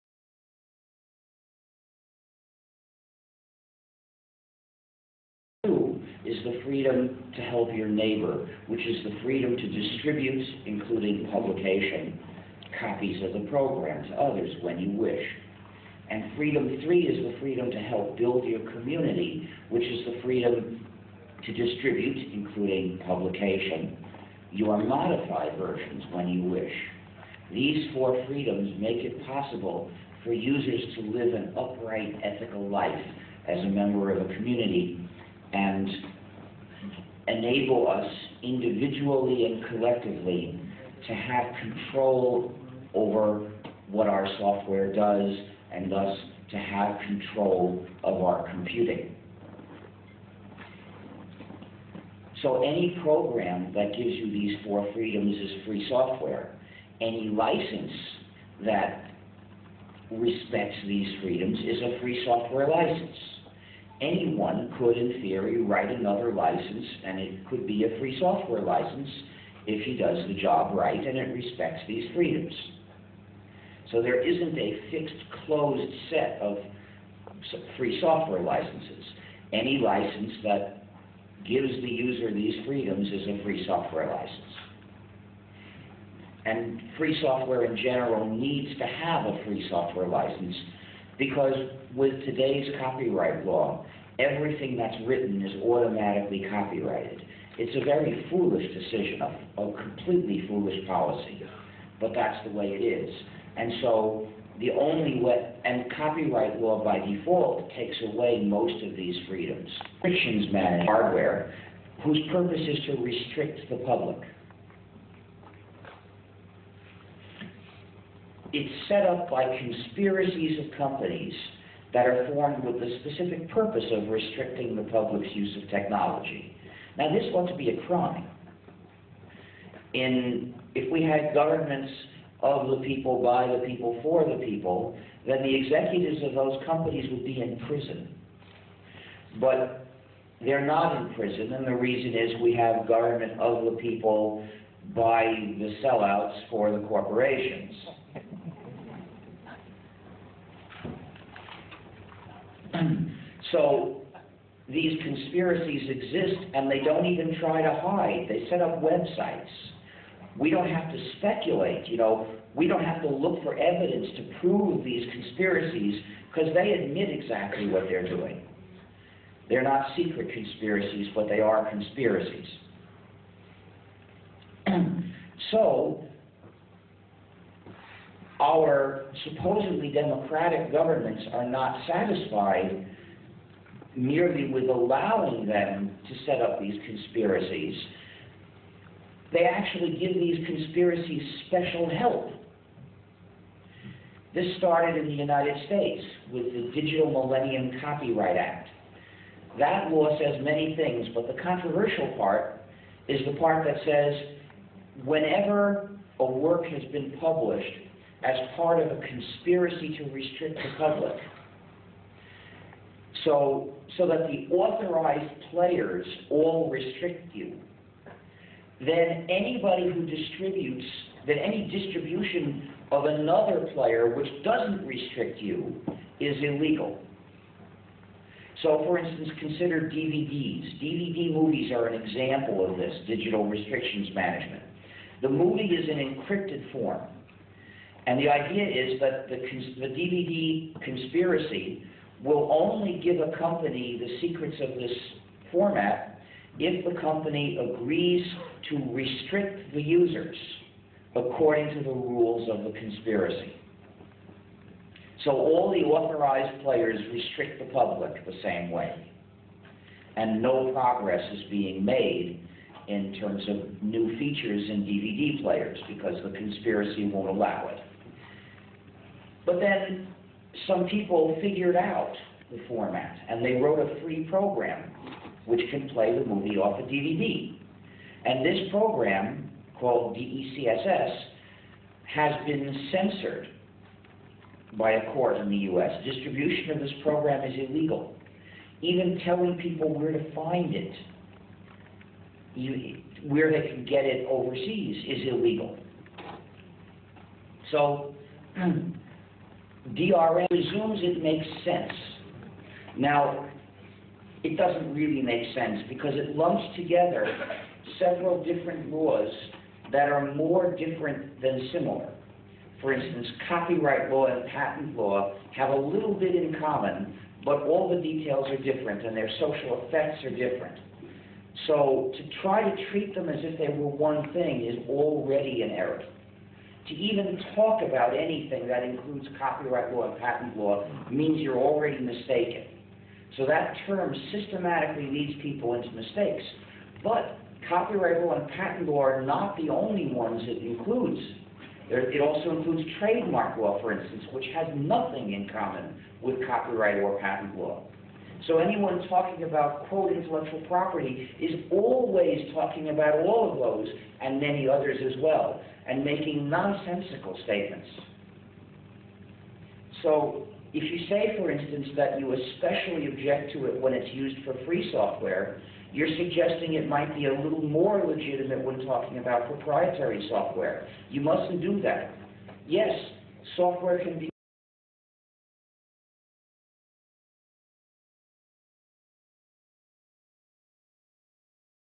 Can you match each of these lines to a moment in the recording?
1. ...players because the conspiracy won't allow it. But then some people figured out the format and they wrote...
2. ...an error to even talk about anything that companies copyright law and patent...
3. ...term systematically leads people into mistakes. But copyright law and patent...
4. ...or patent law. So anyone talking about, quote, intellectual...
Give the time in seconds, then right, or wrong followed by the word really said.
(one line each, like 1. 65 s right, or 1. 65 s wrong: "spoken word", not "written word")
1. 265 s right
2. 325 s wrong: "includes", not "companies"
3. 333 s right
4. 346 s right.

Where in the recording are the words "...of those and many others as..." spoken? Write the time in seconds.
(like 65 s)
353 s.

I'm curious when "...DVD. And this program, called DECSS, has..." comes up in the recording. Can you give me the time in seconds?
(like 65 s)
276 s.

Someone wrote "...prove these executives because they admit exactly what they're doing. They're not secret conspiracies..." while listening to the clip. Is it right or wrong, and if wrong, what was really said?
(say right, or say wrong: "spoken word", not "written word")
wrong: "conspiracies", not "executives".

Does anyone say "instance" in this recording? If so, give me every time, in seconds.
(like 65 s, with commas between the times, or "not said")
228 s, 312 s, 343 s, 361 s.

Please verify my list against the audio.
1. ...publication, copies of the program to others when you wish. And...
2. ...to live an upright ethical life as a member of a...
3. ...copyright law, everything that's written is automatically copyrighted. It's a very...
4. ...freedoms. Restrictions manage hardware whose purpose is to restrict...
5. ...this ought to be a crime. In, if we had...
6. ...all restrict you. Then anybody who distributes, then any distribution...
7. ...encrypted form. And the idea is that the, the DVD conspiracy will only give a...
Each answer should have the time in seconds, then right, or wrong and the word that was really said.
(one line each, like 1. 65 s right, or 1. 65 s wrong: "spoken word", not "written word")
1. 11 s right
2. 30 s right
3. 92 s right
4. 109 s right
5. 127 s right
6. 216 s right
7. 235 s right.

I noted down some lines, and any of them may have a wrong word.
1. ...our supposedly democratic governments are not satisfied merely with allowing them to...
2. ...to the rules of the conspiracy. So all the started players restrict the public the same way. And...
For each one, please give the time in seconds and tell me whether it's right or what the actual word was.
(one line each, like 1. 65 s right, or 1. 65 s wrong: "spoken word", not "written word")
1. 178 s right
2. 251 s wrong: "authorized", not "started".